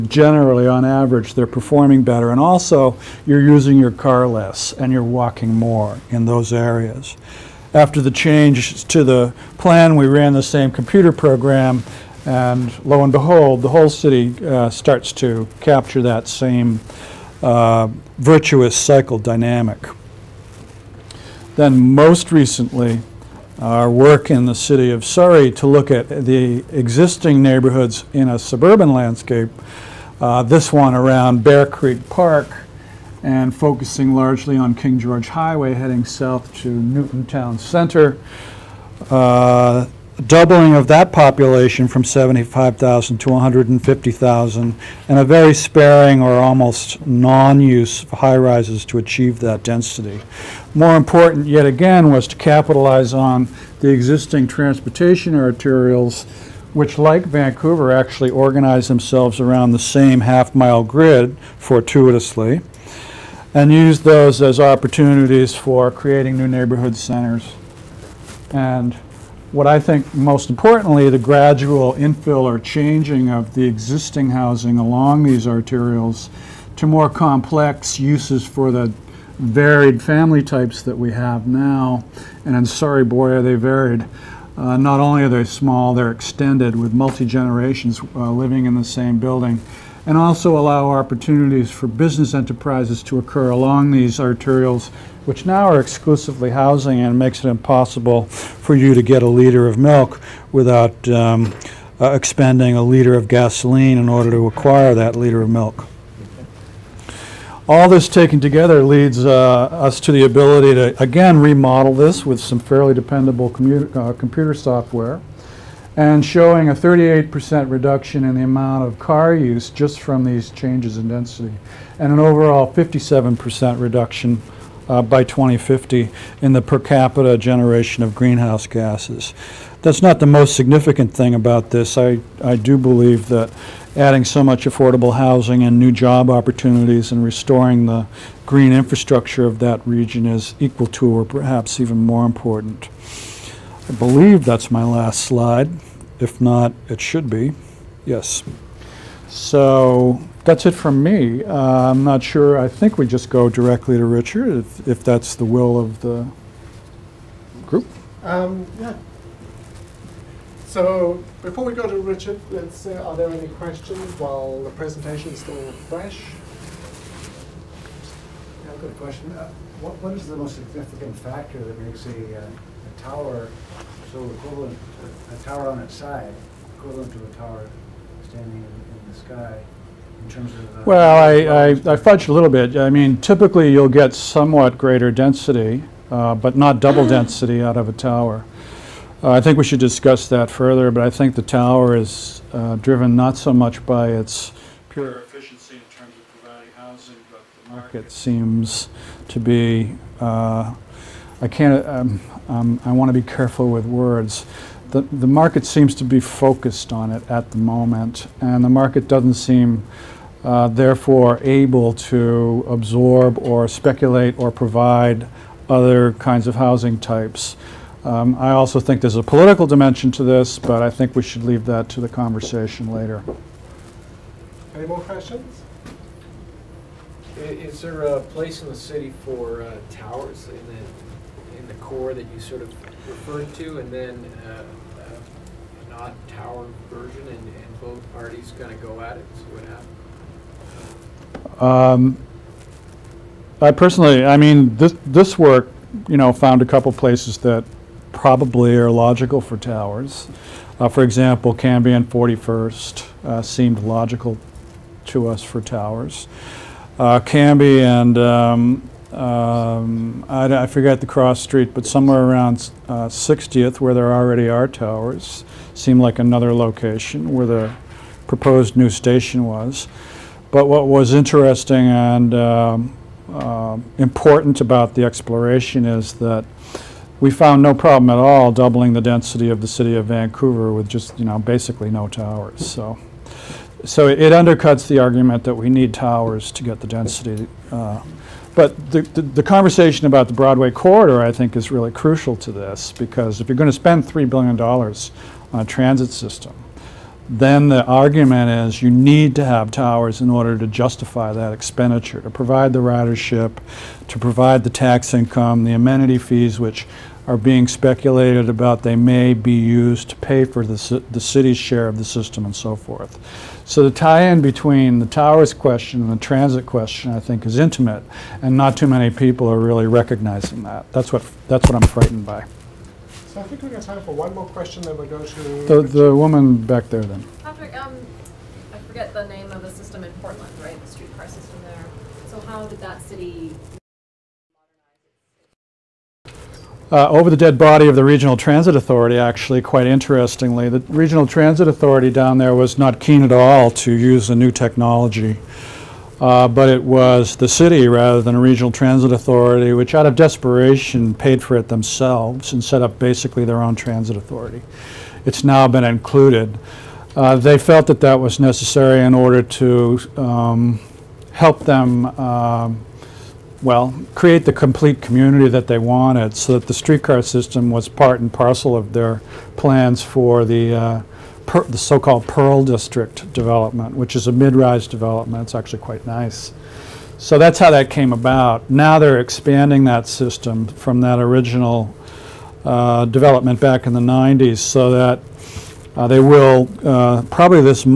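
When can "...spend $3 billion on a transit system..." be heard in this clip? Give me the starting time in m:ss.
4:53.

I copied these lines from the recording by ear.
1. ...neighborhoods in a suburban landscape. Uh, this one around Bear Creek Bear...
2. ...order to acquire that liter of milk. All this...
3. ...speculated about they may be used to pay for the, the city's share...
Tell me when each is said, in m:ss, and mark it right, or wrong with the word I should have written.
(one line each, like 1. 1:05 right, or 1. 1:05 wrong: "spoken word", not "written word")
1. 0:27 wrong: "Park", not "Bear"
2. 1:44 right
3. 5:07 right.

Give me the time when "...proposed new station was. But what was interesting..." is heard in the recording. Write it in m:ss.
4:28.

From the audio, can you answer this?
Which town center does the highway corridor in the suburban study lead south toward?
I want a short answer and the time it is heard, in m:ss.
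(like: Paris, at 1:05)
Newton Town Center, at 0:36.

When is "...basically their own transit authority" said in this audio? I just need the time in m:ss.
5:52.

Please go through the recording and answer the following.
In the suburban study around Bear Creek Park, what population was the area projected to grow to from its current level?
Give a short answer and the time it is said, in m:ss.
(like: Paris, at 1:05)
150,000, at 0:43.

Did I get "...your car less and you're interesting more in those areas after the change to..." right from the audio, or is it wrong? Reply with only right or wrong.
wrong.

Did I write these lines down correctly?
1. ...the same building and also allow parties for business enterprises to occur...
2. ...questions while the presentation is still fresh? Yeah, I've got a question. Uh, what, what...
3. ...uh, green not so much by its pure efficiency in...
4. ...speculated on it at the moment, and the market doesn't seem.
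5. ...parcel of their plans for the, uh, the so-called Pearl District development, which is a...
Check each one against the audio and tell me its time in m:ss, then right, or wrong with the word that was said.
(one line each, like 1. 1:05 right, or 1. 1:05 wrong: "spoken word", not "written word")
1. 1:28 wrong: "opportunities", not "parties"
2. 2:43 right
3. 3:12 wrong: "driven", not "green"
4. 3:26 wrong: "focused", not "speculated"
5. 6:08 right.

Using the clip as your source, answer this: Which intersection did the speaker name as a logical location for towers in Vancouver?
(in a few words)
Cambie and 41st.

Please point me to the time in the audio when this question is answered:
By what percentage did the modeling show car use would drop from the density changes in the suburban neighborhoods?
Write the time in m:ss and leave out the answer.
1:56.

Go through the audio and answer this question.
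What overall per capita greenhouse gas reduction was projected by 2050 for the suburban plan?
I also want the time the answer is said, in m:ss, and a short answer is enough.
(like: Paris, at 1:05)
57%, at 2:02.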